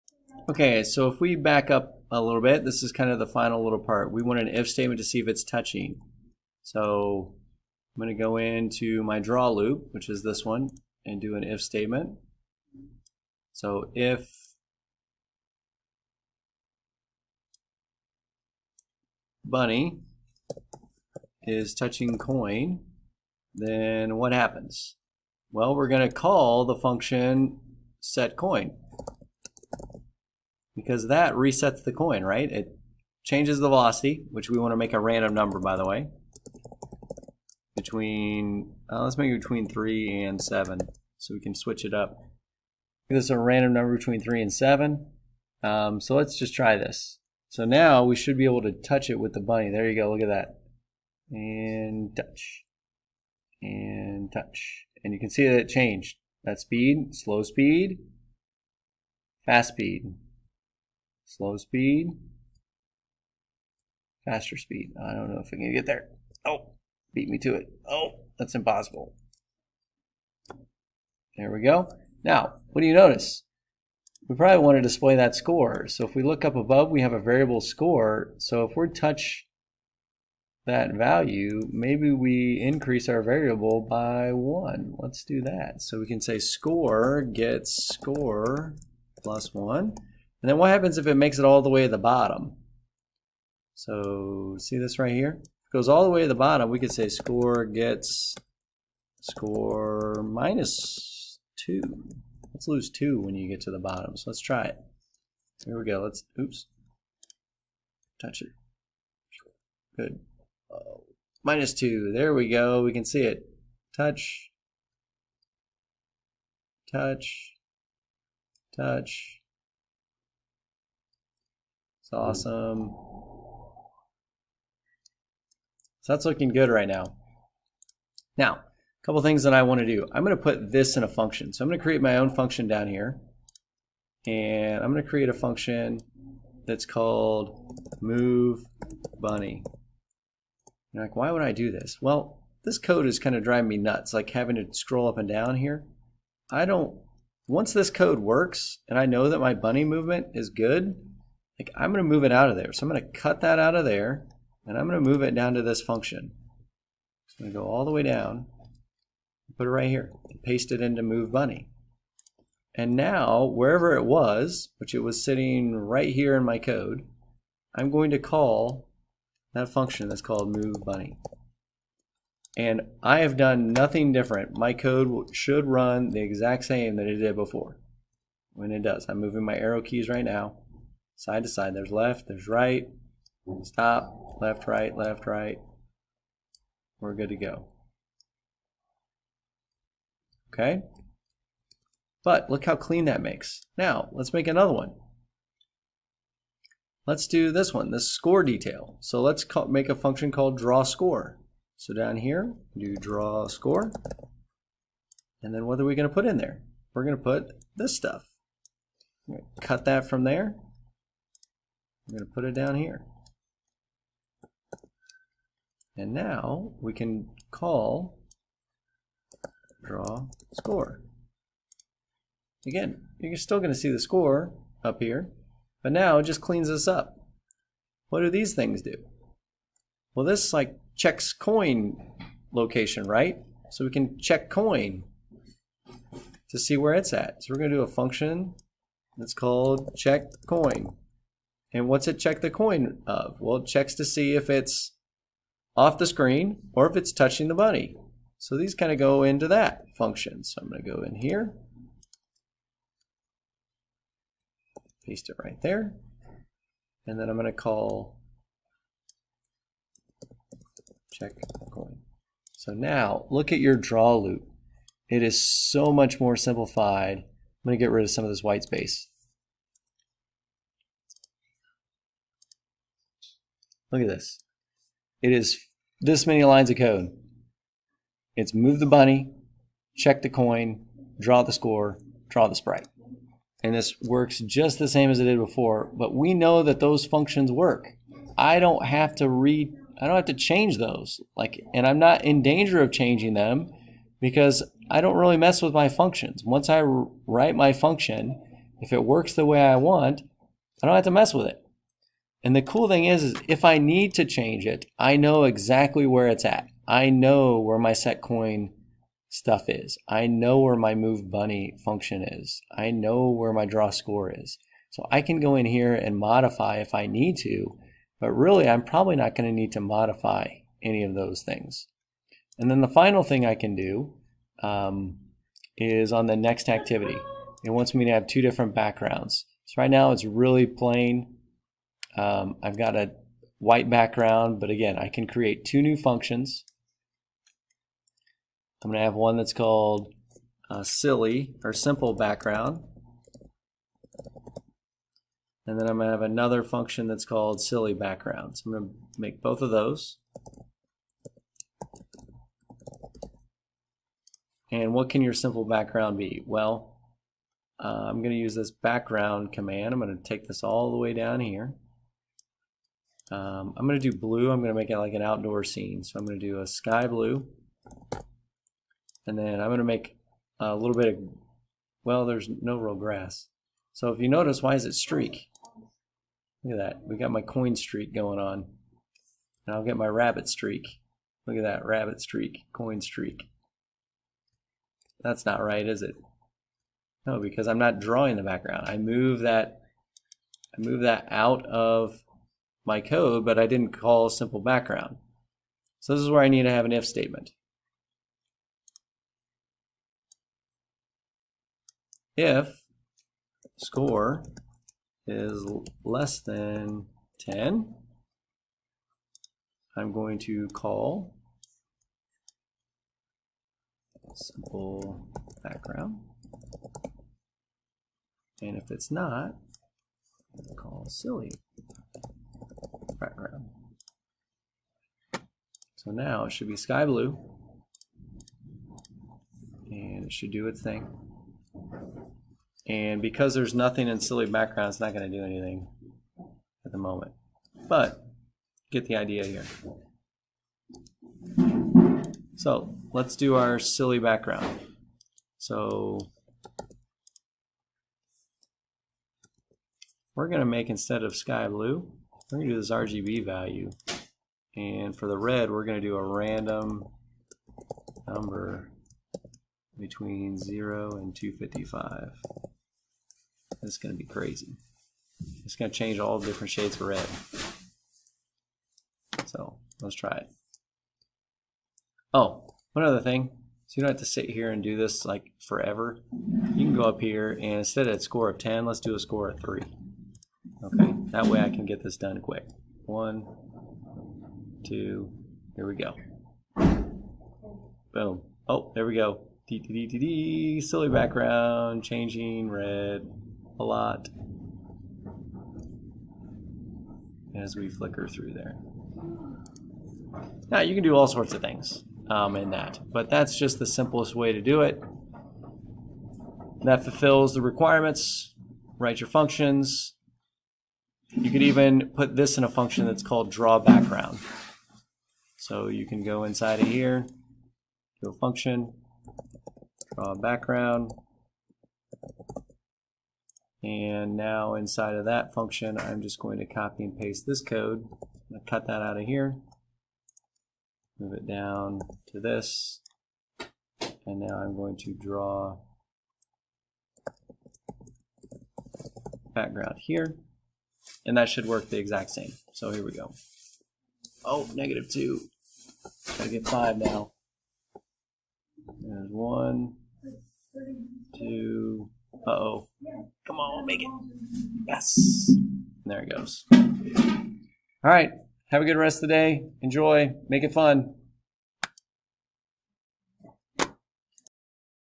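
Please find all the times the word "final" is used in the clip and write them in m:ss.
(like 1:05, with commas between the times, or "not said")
0:03, 5:22.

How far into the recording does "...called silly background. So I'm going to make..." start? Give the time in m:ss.
5:47.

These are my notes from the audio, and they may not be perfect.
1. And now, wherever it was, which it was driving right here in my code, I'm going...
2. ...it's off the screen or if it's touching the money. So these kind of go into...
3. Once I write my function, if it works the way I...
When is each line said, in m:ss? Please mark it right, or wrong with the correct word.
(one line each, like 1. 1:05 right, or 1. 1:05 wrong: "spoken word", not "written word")
1. 2:42 wrong: "sitting", not "driving"
2. 4:04 right
3. 4:56 right.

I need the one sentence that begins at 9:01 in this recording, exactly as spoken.
And that should work the exact same.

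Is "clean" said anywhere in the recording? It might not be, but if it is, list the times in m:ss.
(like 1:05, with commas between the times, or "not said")
3:12, 3:46.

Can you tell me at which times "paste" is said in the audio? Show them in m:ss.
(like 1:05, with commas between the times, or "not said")
2:40, 4:15, 8:47.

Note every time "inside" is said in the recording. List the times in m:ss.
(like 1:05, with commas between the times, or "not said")
8:36, 8:44.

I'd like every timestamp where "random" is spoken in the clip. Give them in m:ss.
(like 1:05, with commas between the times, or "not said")
0:34, 0:43, 7:36.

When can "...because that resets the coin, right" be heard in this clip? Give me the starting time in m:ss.
0:30.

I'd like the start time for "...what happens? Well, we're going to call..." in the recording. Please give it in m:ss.
0:24.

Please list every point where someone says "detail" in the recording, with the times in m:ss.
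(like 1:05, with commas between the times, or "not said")
3:18.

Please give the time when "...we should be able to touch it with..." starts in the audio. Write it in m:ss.
0:48.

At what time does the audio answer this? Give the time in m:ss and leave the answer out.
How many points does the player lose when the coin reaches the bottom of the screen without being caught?
1:39.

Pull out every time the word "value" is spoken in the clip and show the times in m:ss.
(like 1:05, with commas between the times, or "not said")
1:20, 7:33.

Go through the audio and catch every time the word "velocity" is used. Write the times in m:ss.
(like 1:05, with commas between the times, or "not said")
0:33.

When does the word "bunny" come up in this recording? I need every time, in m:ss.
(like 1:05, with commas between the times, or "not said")
0:19, 0:49, 2:19, 2:29, 2:41, 2:50, 4:38, 5:11.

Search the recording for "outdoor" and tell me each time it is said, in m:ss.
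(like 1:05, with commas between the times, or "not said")
6:05.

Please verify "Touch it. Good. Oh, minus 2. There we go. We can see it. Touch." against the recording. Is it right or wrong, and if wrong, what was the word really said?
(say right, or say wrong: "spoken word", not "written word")
right.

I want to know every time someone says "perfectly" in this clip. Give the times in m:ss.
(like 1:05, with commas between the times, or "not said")
not said.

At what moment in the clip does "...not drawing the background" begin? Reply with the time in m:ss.
6:27.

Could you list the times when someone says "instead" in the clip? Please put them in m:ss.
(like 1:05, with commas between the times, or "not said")
7:30, 7:57.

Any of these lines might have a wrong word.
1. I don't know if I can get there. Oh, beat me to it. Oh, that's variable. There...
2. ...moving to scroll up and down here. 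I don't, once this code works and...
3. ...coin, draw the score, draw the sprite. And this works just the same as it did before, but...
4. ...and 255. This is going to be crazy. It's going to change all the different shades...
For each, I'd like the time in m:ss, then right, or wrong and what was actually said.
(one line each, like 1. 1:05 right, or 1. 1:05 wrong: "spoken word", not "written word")
1. 1:05 wrong: "impossible", not "variable"
2. 2:24 wrong: "having", not "moving"
3. 4:40 right
4. 7:41 right.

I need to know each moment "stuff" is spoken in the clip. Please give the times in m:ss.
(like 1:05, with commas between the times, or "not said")
3:27, 5:09.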